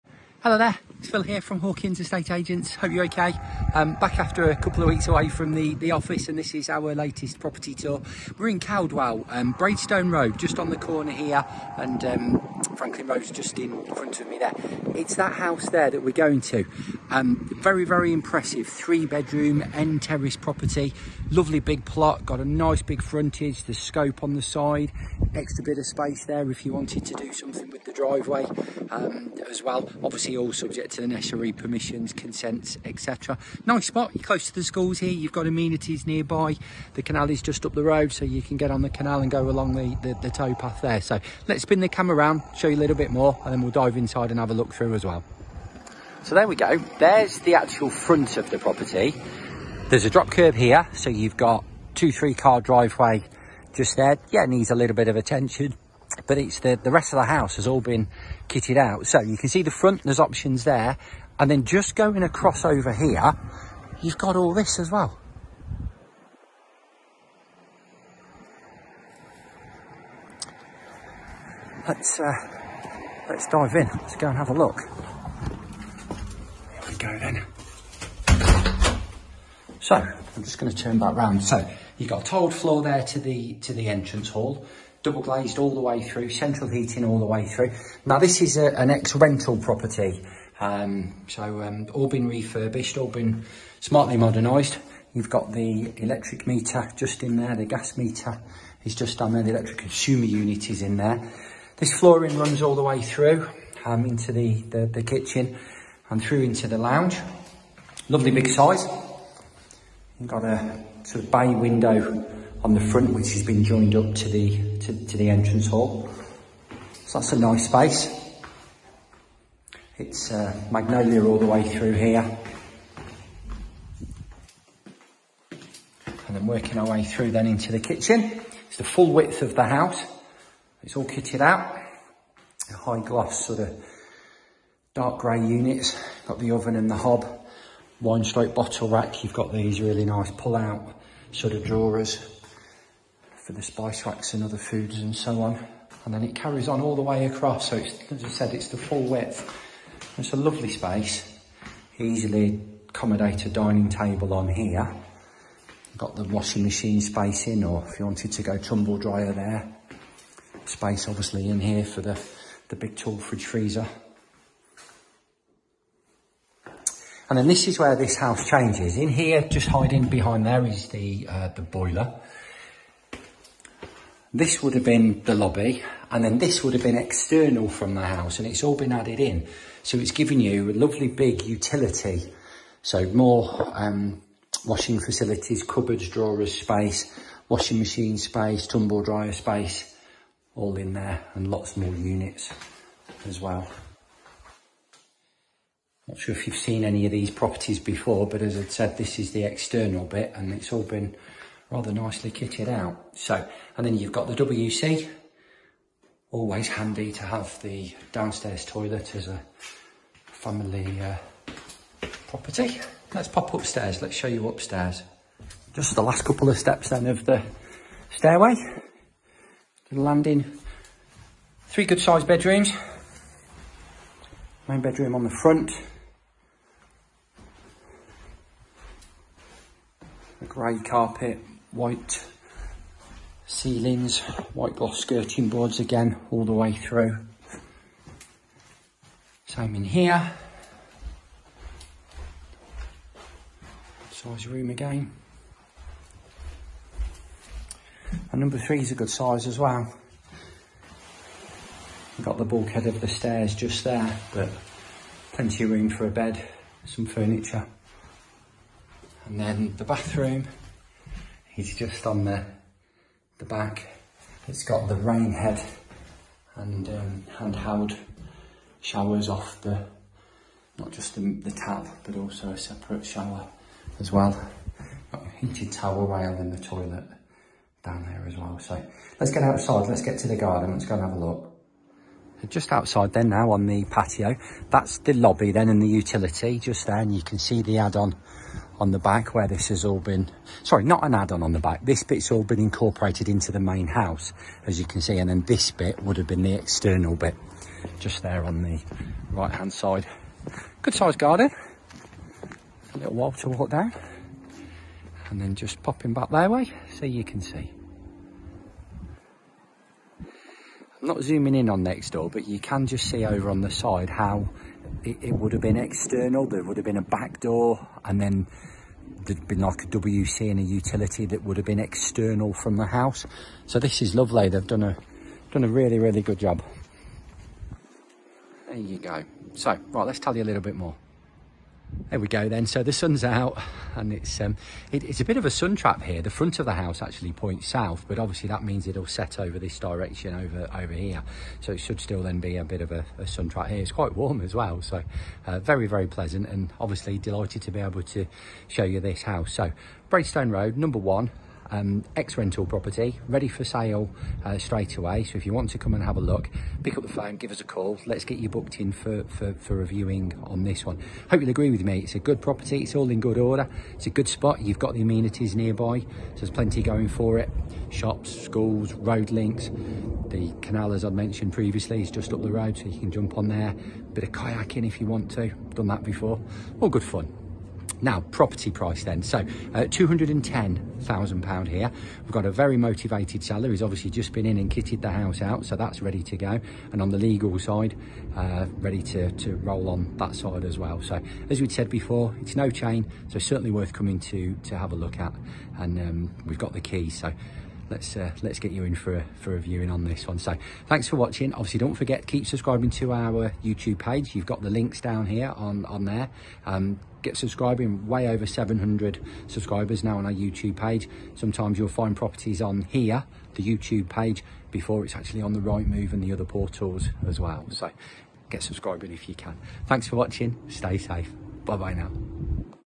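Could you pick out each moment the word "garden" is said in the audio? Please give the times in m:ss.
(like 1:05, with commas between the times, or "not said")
4:40, 5:01.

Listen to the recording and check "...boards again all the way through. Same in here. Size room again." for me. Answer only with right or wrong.
right.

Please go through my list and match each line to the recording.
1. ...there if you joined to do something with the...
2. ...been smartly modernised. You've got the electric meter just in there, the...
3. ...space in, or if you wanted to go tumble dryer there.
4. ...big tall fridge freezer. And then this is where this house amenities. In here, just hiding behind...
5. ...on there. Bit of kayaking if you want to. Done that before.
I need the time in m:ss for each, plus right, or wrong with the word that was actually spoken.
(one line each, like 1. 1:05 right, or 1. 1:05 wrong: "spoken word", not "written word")
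1. 0:26 wrong: "wanted", not "joined"
2. 1:33 right
3. 2:37 right
4. 2:42 wrong: "changes", not "amenities"
5. 6:13 right.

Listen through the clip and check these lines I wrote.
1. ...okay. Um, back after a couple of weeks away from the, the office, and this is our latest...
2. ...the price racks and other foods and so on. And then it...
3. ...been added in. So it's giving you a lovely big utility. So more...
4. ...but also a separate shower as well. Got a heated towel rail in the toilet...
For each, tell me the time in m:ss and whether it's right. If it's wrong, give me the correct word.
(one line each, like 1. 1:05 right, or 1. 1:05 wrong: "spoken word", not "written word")
1. 0:03 right
2. 2:23 wrong: "spice", not "price"
3. 2:58 right
4. 4:32 right.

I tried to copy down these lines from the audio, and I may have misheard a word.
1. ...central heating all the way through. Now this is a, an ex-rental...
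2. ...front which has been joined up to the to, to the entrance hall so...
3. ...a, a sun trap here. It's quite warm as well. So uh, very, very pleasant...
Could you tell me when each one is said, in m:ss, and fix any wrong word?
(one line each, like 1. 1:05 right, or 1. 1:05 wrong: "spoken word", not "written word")
1. 1:26 right
2. 1:52 right
3. 5:42 right.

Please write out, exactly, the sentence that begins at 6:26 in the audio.
And on the legal side, uh, ready to, to roll on that side as well.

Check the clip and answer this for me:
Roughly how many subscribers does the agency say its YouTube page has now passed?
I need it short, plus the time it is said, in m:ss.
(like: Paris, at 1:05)
700, at 6:48.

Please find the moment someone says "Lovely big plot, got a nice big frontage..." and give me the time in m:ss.
0:21.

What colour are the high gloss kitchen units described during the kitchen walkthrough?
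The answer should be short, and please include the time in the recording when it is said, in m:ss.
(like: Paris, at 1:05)
Dark grey, at 2:14.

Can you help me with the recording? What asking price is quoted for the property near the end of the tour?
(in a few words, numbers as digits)
£210,000.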